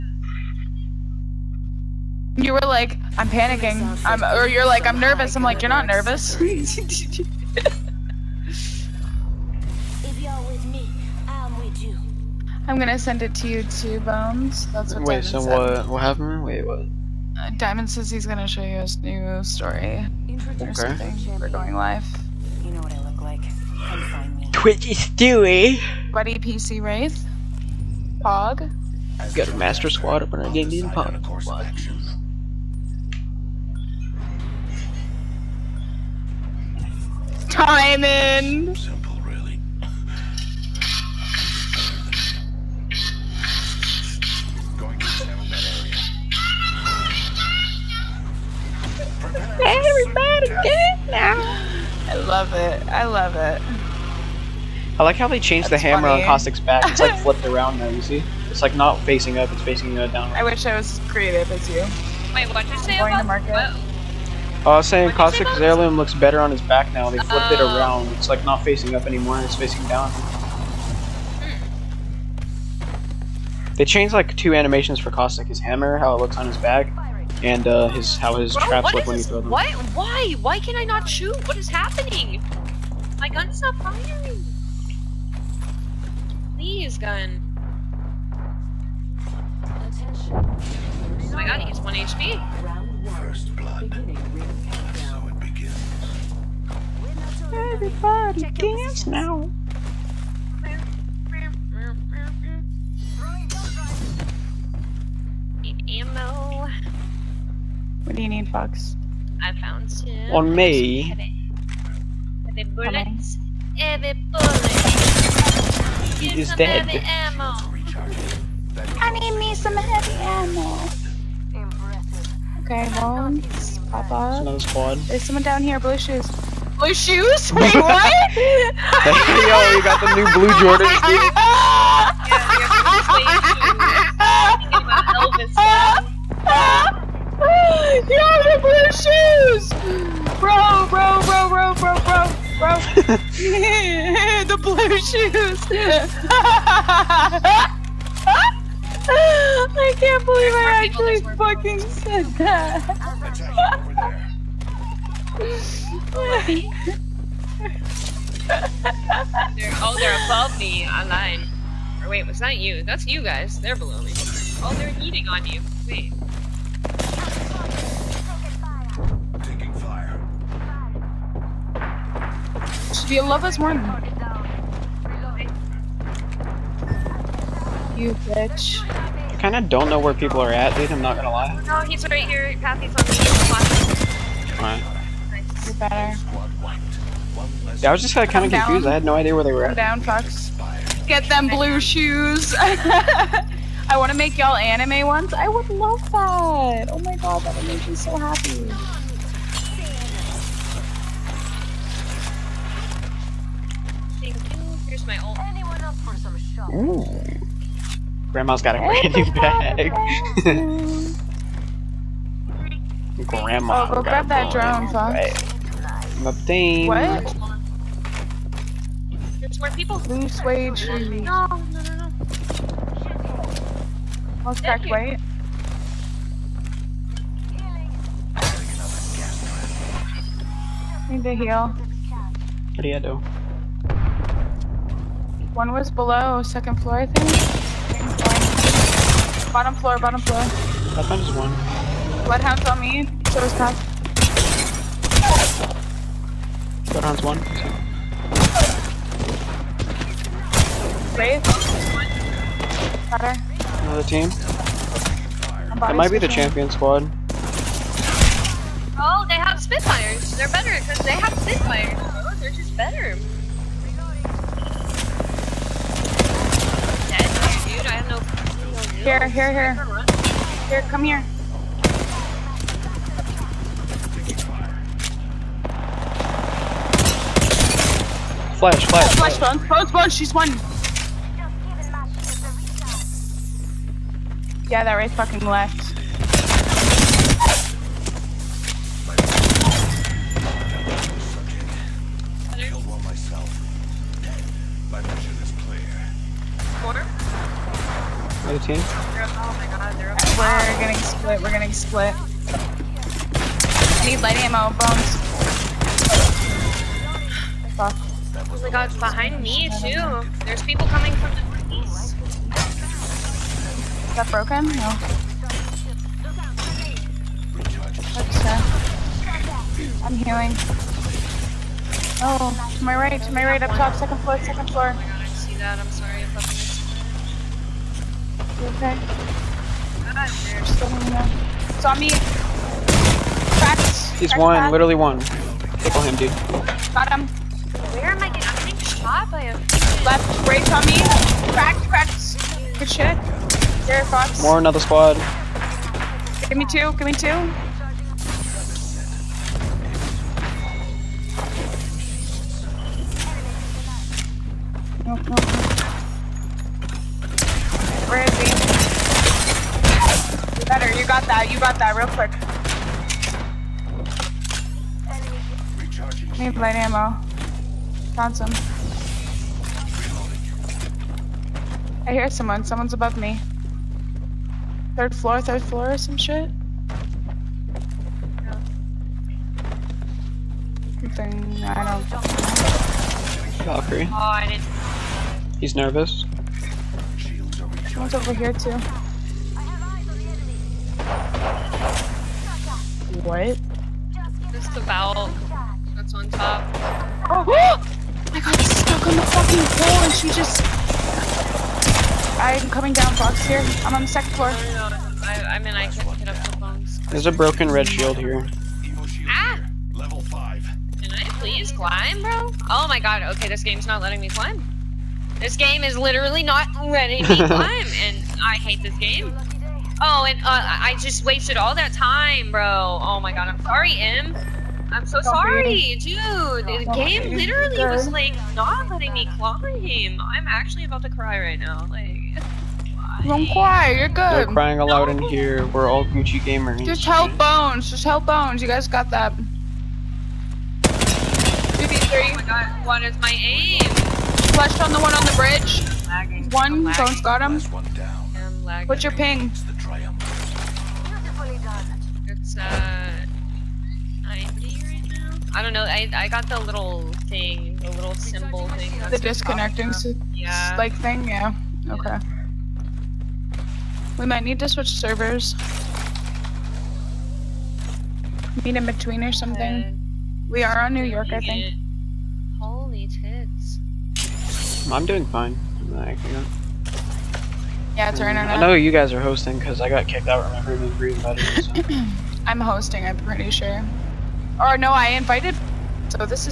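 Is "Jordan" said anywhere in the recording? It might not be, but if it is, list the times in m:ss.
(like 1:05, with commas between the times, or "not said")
2:10.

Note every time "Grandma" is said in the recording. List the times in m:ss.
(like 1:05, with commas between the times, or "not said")
3:28, 3:33.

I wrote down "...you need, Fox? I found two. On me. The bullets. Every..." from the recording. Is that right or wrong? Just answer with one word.
right.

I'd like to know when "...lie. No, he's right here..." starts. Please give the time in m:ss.
3:01.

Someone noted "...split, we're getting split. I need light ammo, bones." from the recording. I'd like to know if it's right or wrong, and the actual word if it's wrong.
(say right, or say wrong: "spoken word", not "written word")
right.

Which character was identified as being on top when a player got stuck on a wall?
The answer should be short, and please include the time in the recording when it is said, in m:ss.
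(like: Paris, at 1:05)
Valkyrie, at 6:23.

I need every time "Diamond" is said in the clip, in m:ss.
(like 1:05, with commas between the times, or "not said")
0:17, 0:37.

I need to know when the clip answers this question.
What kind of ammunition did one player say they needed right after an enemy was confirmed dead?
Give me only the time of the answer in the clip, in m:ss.
1:59.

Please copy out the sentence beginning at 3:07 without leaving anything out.
Yeah, I was just kinda, confused, I had no idea where they were Come at.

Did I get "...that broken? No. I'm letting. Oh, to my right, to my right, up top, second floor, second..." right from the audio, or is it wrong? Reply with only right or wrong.
wrong.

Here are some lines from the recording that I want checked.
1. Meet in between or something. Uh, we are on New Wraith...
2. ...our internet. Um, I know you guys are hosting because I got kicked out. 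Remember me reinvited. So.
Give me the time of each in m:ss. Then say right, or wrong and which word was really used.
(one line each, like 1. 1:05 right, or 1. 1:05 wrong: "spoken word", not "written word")
1. 7:48 wrong: "York", not "Wraith"
2. 7:58 right.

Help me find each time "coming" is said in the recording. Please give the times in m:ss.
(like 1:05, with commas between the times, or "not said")
5:10, 6:42.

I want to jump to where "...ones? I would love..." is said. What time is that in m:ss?
3:15.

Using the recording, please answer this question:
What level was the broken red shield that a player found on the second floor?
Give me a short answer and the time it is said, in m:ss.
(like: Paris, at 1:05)
5, at 6:49.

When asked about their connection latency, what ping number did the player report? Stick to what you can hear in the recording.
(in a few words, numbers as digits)
90.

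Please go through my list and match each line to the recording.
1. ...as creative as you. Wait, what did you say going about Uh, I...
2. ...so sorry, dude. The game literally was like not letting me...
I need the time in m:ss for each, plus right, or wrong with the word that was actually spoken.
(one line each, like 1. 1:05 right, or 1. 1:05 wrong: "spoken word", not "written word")
1. 1:00 right
2. 7:05 right.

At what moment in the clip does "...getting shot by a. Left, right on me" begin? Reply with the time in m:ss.
5:38.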